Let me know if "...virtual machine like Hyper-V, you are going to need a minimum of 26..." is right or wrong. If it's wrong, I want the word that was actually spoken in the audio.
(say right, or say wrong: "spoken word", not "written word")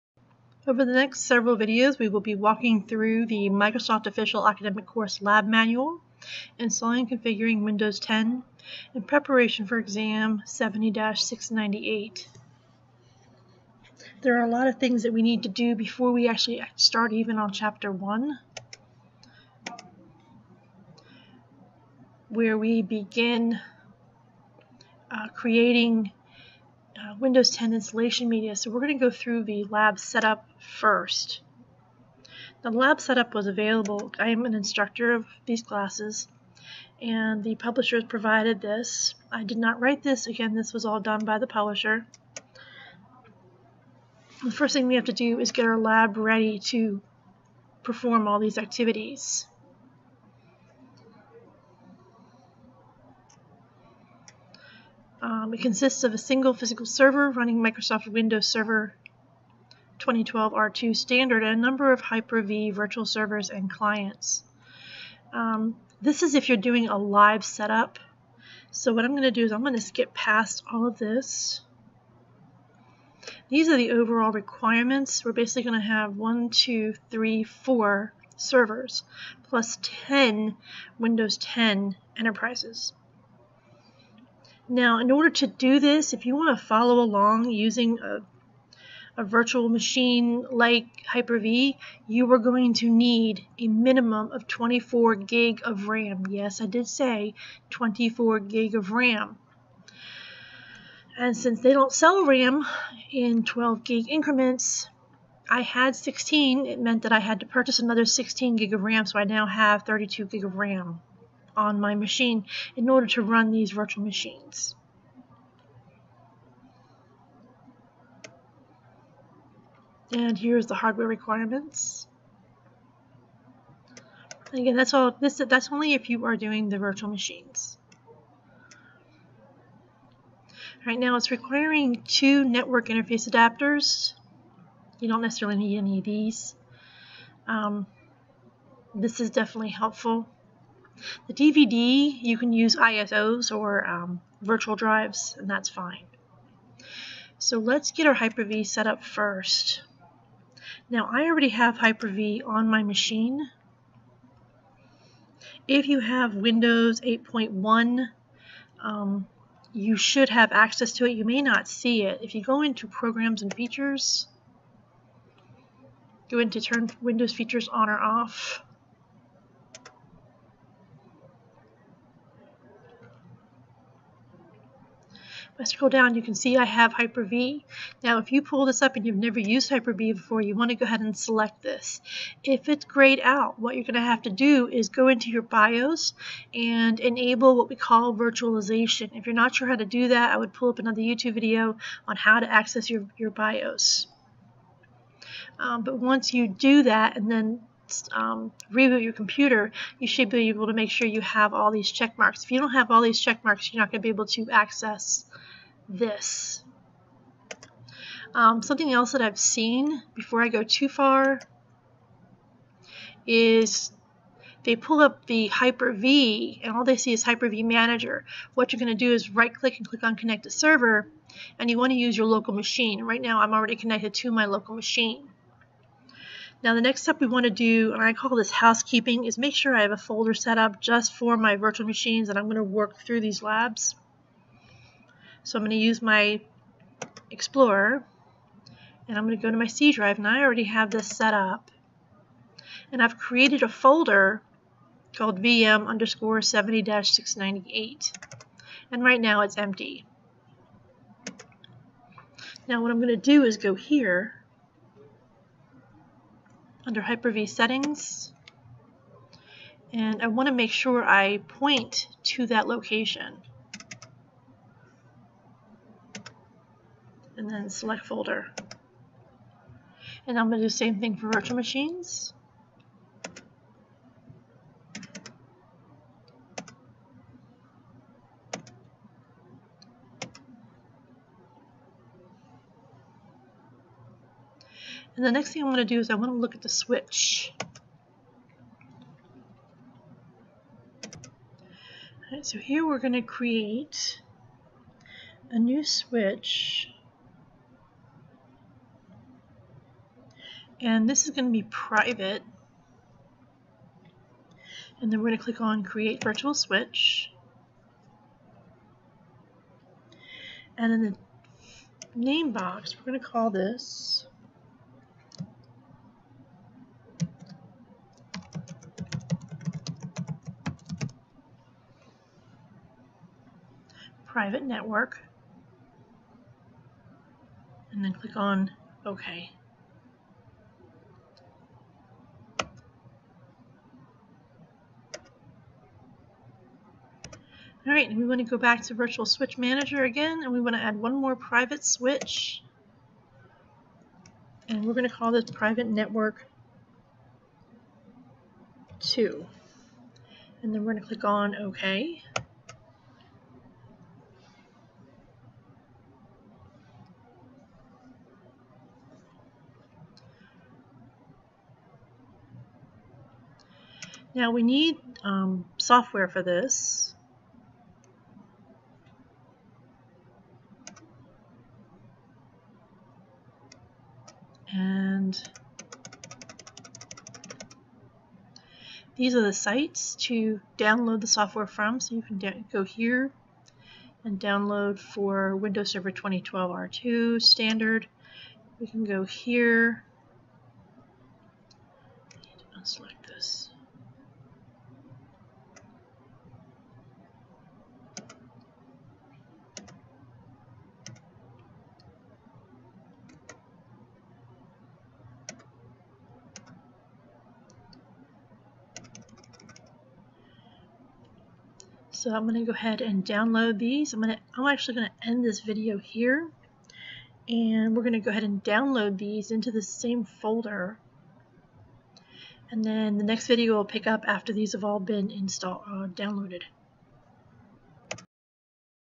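wrong: "24", not "26".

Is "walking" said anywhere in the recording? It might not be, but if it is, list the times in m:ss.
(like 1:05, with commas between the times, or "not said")
0:02.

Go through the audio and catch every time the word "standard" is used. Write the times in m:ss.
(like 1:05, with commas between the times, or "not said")
1:00, 6:27.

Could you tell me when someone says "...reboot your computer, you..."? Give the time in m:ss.
3:18.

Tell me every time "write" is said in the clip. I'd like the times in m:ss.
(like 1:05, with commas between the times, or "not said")
0:39.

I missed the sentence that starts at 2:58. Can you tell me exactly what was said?
Now, if you pull this up and you've never used Hyper-V before, you want to go ahead and select this.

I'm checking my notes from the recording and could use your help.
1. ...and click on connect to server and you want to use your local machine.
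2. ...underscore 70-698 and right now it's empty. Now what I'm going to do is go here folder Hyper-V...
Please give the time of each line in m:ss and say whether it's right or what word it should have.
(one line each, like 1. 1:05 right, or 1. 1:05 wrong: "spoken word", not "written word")
1. 3:39 right
2. 4:05 wrong: "under", not "folder".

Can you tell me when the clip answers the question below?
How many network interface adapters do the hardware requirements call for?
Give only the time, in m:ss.
2:12.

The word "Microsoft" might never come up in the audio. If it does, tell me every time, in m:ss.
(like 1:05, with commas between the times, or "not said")
0:03, 0:57.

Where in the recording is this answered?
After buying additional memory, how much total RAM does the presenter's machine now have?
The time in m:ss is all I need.
1:49.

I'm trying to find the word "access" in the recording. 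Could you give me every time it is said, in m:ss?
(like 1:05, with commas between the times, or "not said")
2:40, 3:12, 3:24.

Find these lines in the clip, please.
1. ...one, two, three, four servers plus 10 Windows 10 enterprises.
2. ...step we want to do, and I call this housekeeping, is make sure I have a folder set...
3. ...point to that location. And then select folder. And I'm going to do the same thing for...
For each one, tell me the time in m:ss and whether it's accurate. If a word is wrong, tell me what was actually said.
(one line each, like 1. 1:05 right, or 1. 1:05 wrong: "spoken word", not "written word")
1. 1:16 right
2. 3:47 right
3. 4:21 right.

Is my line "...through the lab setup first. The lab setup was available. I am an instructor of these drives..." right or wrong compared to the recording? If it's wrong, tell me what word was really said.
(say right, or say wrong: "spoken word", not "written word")
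wrong: "classes", not "drives".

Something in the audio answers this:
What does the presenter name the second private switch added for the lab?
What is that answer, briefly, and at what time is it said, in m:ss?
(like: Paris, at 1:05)
Private Network 2, at 5:45.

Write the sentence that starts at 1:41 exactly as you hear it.
And since they don't sell RAM in 12 gig increments, I had 16.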